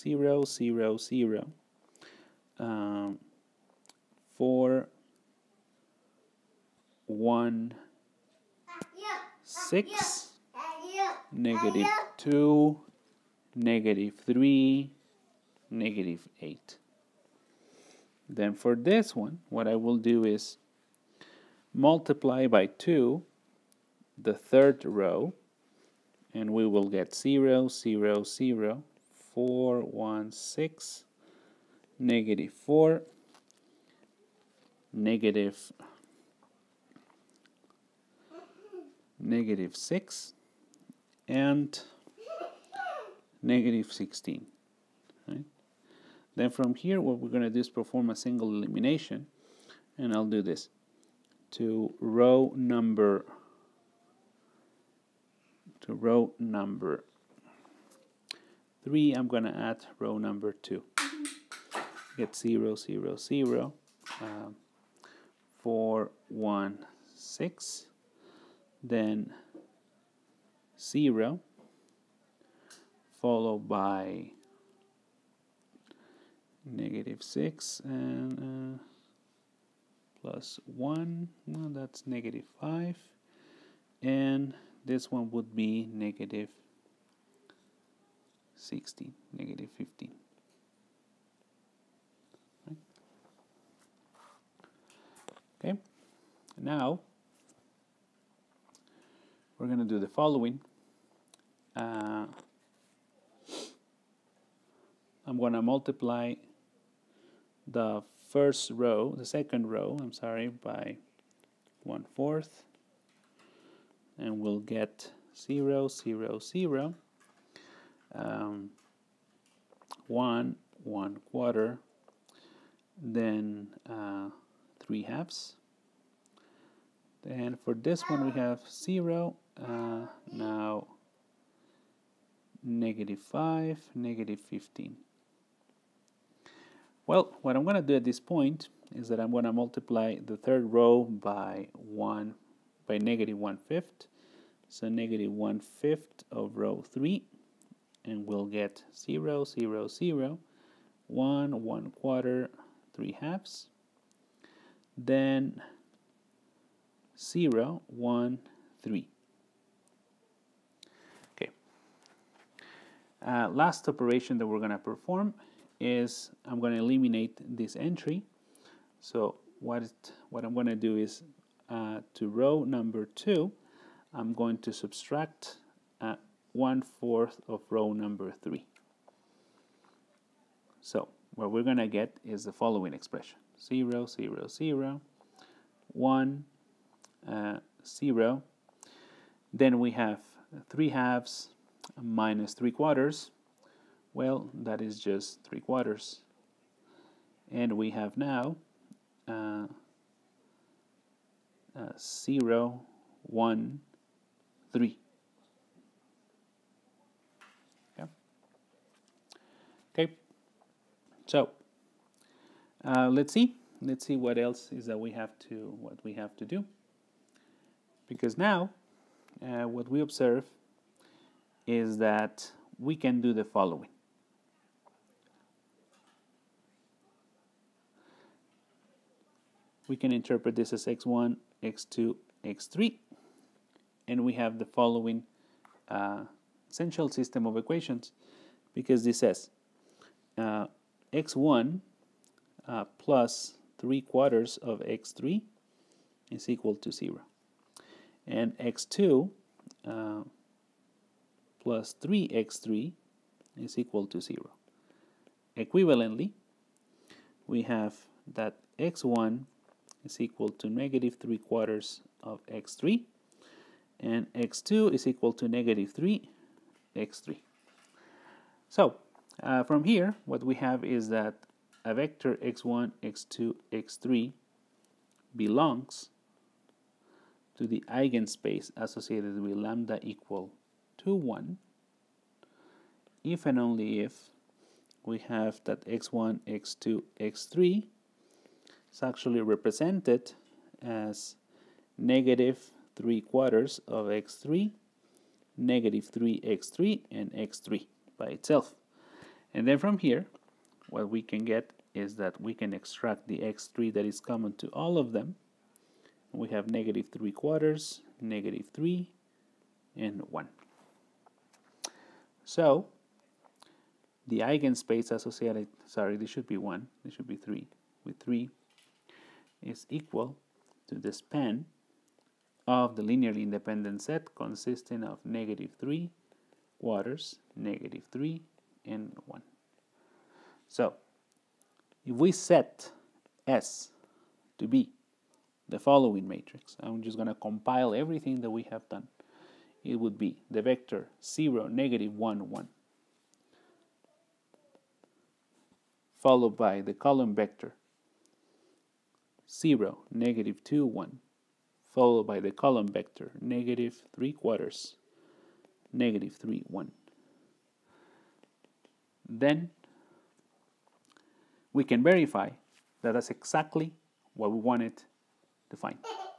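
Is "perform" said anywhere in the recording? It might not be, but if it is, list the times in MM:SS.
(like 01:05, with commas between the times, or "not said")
00:47, 02:44.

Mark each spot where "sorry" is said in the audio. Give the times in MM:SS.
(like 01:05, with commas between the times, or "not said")
01:50, 05:15.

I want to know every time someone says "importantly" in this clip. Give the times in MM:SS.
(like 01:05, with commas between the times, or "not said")
not said.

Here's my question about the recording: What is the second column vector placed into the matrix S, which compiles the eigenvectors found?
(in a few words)
(0, -2, 1).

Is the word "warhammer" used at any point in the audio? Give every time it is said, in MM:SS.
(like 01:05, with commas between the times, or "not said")
not said.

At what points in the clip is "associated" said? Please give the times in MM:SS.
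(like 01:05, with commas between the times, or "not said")
04:38, 05:15.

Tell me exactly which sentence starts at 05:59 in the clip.
Then we can verify that that's exactly what we wanted to find.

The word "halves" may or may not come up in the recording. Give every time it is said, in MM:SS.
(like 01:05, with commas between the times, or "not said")
02:05, 02:33, 03:10.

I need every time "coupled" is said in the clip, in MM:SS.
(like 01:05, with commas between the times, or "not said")
not said.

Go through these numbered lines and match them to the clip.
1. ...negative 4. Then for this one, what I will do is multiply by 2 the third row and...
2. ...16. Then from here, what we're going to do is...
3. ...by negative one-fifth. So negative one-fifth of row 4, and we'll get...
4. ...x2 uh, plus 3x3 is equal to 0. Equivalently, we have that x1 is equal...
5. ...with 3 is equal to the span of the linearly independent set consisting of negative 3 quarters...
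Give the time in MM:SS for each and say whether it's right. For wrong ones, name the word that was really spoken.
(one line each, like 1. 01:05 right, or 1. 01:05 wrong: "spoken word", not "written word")
1. 00:15 wrong: "8", not "4"
2. 00:43 right
3. 02:22 wrong: "3", not "4"
4. 04:08 right
5. 05:18 right.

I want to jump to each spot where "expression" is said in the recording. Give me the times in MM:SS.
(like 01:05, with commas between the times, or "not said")
03:02.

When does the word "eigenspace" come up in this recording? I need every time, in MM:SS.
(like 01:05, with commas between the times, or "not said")
04:37, 05:14.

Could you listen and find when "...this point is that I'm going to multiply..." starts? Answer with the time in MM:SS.
02:18.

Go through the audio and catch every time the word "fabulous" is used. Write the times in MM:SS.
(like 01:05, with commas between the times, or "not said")
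not said.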